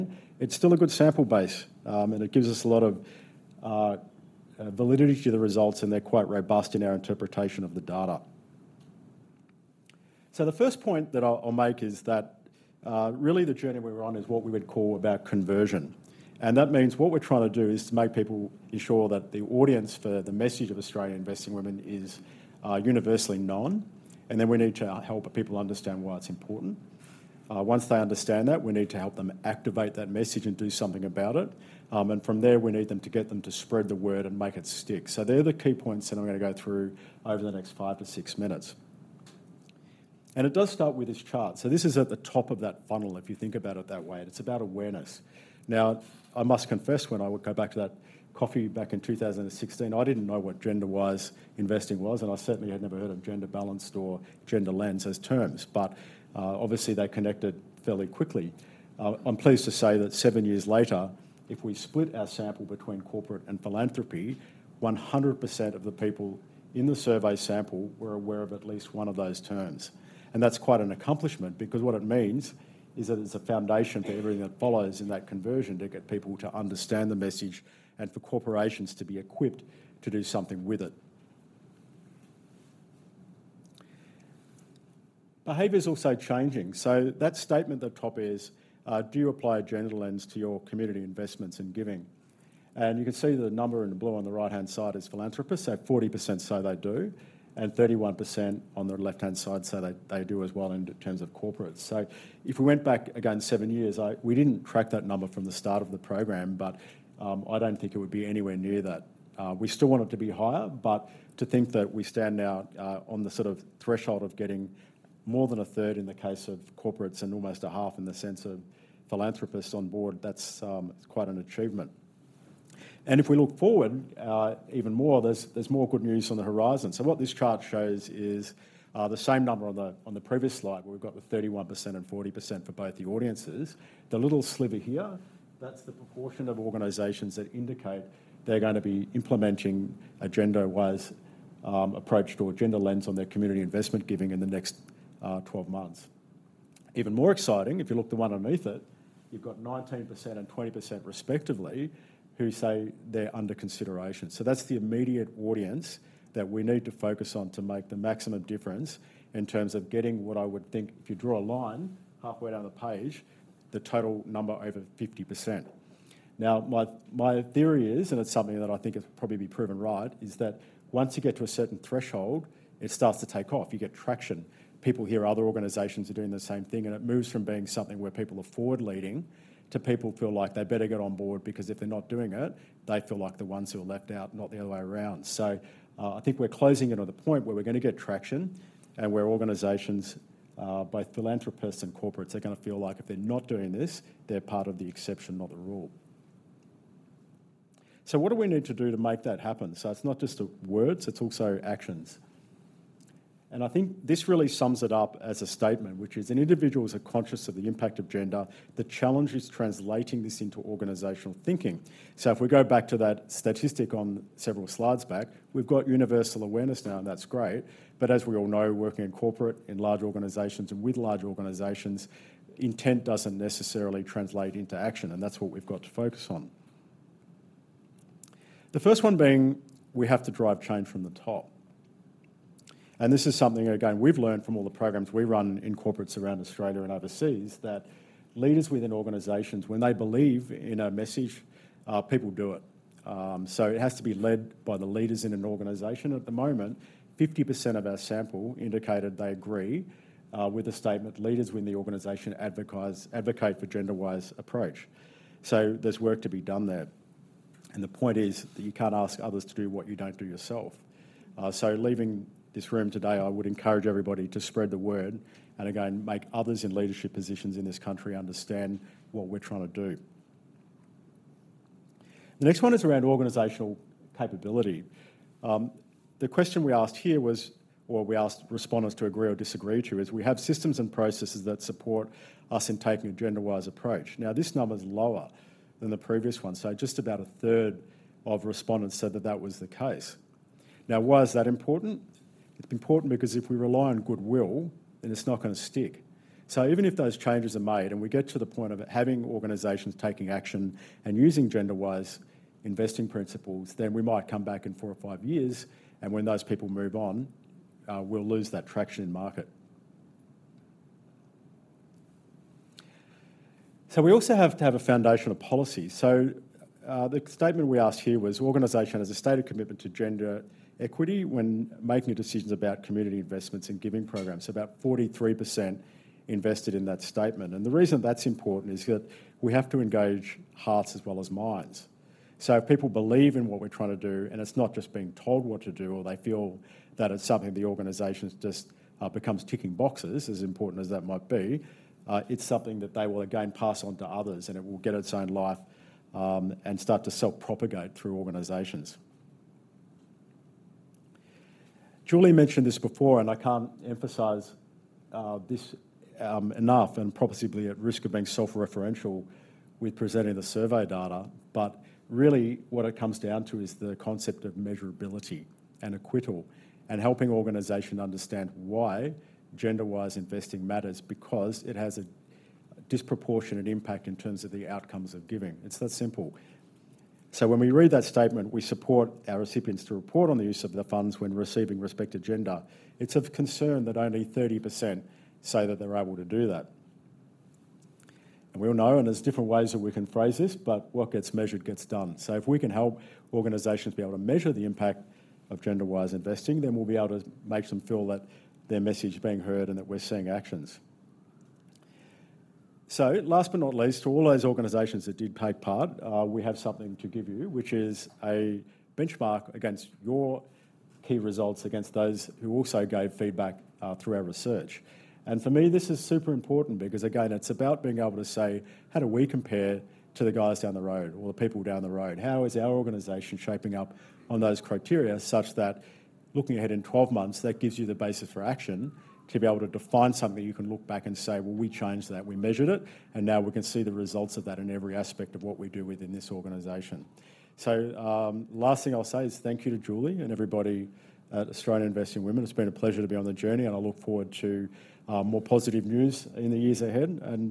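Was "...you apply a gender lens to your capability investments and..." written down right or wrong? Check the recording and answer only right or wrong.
wrong.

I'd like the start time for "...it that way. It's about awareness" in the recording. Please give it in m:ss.
0:43.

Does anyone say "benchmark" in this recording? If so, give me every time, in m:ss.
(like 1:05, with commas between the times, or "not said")
6:48.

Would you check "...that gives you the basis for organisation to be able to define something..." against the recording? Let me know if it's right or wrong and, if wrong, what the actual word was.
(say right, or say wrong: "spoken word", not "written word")
wrong: "action", not "organisation".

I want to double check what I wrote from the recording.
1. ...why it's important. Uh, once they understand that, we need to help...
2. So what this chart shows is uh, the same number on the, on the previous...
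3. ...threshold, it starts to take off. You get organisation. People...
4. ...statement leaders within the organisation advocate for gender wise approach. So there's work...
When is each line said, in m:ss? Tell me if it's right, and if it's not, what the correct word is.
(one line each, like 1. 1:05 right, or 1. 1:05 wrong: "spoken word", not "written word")
1. 0:26 right
2. 2:06 right
3. 2:51 wrong: "traction", not "organisation"
4. 4:10 right.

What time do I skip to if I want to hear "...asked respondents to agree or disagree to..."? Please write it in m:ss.
4:38.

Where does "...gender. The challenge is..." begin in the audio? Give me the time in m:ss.
3:28.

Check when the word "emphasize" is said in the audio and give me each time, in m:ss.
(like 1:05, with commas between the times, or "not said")
5:53.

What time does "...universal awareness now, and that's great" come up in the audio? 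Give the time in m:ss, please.
3:35.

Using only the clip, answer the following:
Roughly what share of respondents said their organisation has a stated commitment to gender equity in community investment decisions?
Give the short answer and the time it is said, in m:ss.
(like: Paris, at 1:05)
43%, at 5:24.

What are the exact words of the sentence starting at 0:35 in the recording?
So they're the key points that I'm going to go through over the next five to six minutes.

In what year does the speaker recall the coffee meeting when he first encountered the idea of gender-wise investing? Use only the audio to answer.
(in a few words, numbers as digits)
2016.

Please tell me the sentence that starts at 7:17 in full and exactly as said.
So, um, last thing I'll say is thank you to Julie and everybody at Australian Investing Women.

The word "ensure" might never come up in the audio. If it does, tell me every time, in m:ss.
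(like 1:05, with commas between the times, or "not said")
0:18.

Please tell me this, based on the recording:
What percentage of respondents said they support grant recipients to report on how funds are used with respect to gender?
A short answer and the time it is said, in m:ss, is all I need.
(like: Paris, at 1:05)
30%, at 6:24.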